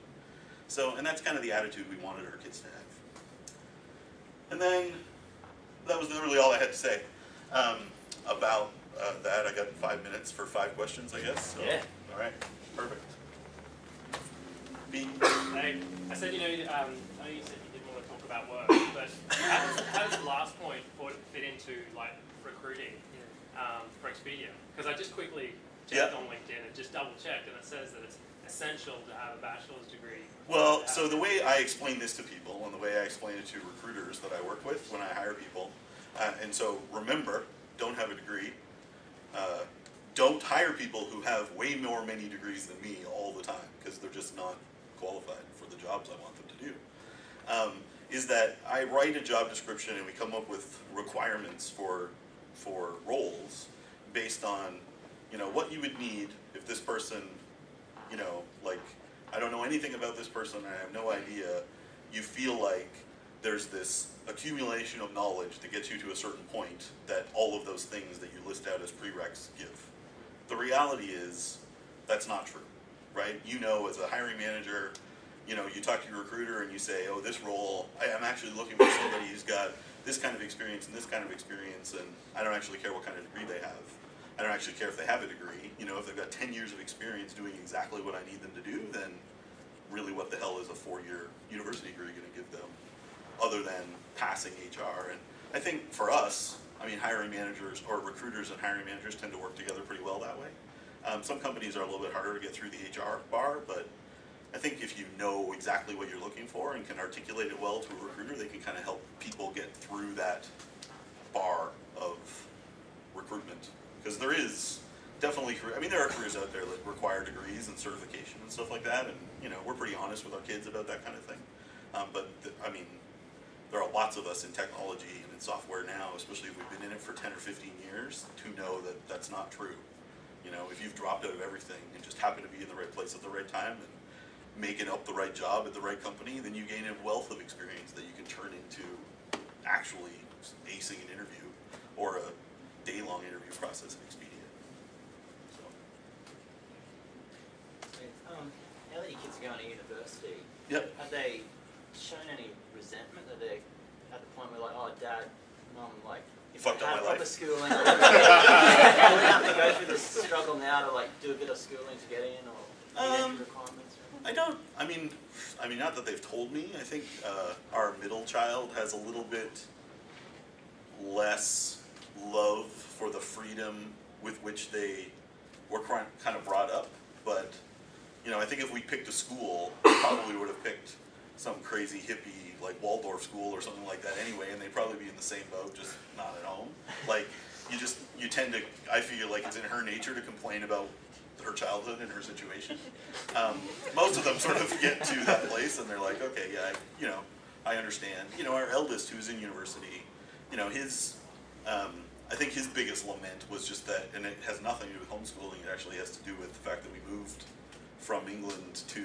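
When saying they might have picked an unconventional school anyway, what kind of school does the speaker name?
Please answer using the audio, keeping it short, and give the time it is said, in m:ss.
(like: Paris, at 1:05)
Waldorf school, at 3:02.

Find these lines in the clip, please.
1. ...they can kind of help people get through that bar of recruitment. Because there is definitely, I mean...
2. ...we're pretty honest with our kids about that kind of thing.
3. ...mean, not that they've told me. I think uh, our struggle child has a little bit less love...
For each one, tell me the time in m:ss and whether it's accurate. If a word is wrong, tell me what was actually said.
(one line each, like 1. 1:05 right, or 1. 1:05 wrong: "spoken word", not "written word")
1. 1:48 right
2. 1:59 right
3. 2:45 wrong: "middle", not "struggle".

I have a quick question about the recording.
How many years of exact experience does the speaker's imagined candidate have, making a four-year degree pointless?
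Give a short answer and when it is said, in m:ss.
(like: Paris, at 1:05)
10, at 1:26.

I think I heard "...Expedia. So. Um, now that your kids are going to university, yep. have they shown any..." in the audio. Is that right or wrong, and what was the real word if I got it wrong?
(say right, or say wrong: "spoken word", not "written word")
right.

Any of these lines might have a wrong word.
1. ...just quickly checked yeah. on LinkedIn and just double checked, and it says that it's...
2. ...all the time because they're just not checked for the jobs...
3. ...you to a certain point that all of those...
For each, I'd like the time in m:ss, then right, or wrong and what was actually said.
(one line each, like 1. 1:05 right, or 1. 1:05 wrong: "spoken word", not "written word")
1. 0:24 right
2. 0:43 wrong: "qualified", not "checked"
3. 1:05 right.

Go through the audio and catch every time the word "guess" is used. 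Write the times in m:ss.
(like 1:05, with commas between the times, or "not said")
0:11.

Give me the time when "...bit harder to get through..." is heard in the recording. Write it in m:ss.
1:41.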